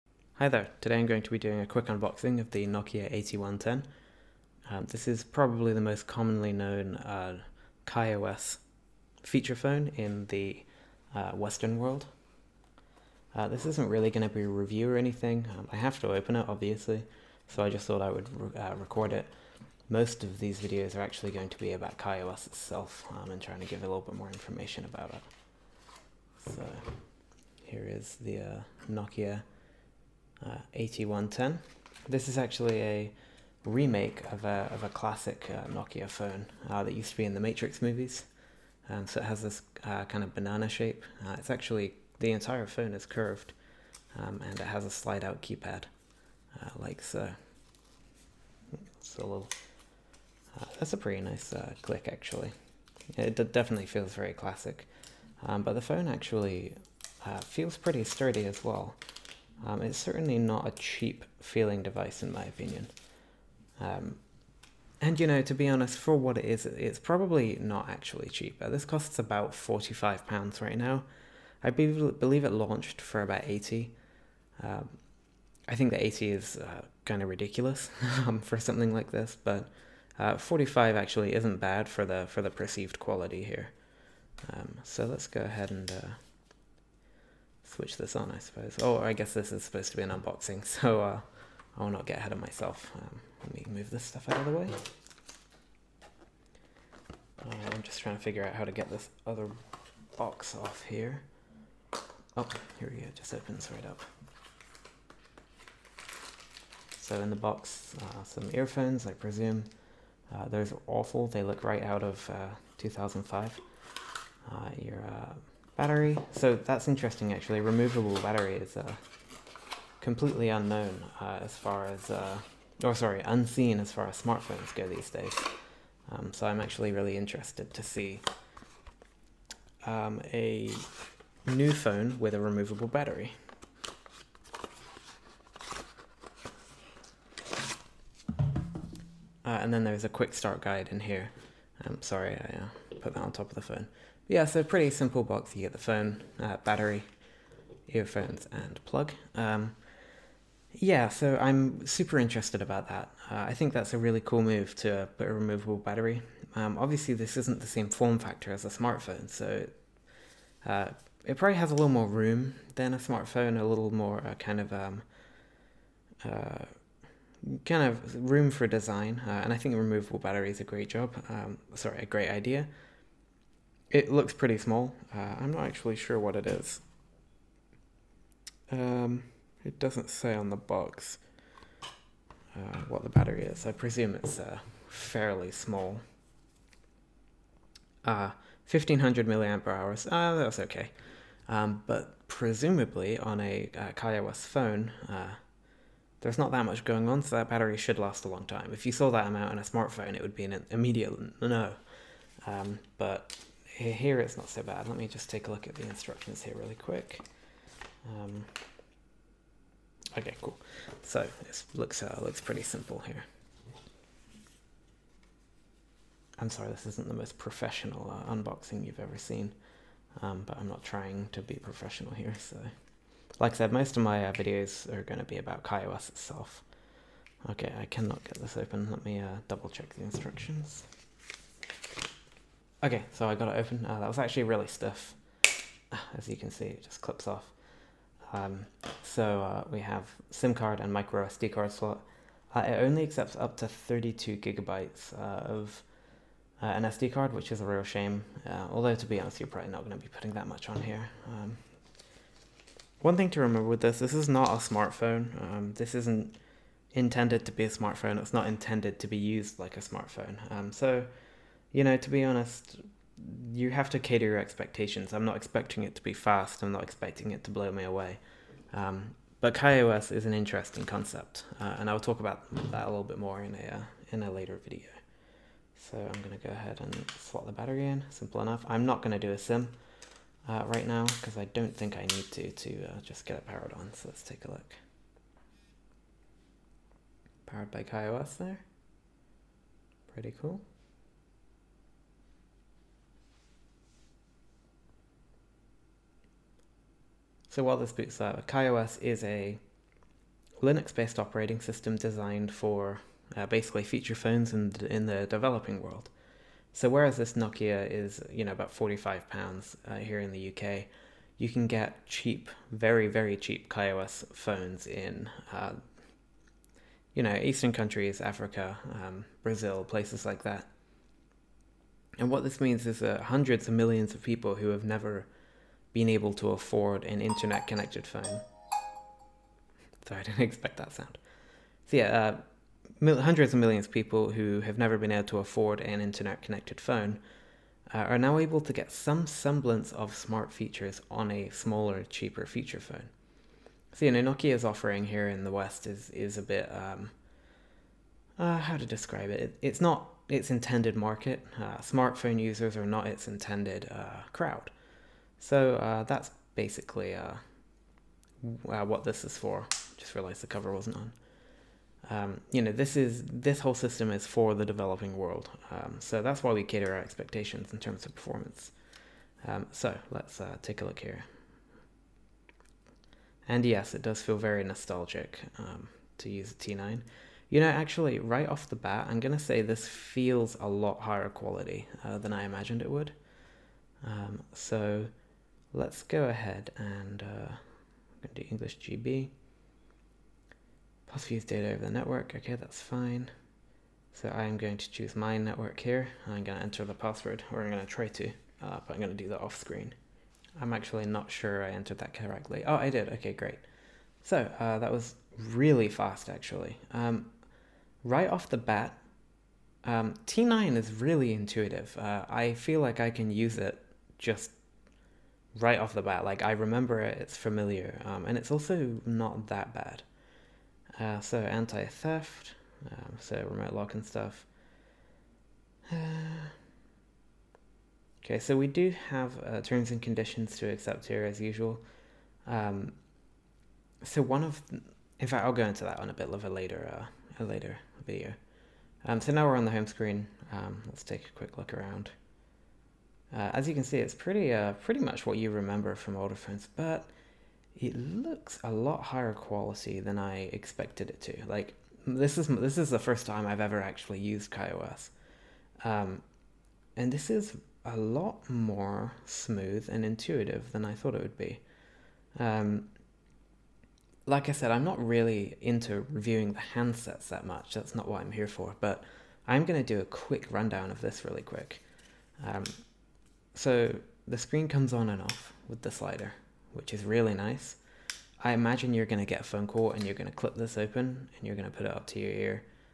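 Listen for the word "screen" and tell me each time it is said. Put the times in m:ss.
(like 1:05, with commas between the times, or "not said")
6:39, 7:19, 7:54.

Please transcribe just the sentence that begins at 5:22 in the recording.
And what this means is that hundreds of millions of people who have never being able to afford an internet connected phone.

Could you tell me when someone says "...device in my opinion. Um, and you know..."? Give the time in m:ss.
1:01.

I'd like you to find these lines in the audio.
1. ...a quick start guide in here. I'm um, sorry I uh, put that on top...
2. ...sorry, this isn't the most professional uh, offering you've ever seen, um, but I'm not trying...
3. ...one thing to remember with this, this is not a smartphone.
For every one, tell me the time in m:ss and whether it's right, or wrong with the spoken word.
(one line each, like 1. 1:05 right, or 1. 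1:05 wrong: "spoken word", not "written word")
1. 2:20 right
2. 3:36 wrong: "unboxing", not "offering"
3. 4:12 right.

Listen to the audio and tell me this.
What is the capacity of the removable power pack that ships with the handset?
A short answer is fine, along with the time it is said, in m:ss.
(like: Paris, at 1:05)
1500 milliampere hours, at 3:08.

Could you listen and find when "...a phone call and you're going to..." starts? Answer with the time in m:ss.
7:59.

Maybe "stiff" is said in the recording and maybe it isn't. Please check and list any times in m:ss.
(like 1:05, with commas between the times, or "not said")
3:54.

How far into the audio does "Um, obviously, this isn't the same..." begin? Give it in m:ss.
2:36.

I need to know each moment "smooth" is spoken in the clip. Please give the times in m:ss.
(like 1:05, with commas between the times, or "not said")
7:39.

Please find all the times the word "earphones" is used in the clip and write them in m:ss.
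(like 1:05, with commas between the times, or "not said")
1:48, 2:27.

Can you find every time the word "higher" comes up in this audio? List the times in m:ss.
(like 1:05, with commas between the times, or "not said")
6:20, 7:29.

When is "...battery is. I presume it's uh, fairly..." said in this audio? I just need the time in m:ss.
3:03.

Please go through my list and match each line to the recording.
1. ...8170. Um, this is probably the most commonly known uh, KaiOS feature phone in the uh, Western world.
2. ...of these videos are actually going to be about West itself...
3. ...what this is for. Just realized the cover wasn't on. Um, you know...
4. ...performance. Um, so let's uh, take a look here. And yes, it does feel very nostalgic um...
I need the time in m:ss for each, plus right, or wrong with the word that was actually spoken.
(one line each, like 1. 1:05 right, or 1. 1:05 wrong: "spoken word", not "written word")
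1. 0:03 wrong: "8110", not "8170"
2. 0:20 wrong: "KaiOS", not "West"
3. 5:58 right
4. 6:08 right.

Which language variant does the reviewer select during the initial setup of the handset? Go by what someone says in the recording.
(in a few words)
English GB.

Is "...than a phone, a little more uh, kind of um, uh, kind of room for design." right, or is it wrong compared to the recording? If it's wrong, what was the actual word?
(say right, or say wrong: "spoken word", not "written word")
wrong: "smartphone", not "phone".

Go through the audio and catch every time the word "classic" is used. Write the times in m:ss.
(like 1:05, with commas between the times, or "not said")
0:34, 0:54.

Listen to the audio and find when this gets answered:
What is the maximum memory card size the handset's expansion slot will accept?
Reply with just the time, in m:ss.
4:03.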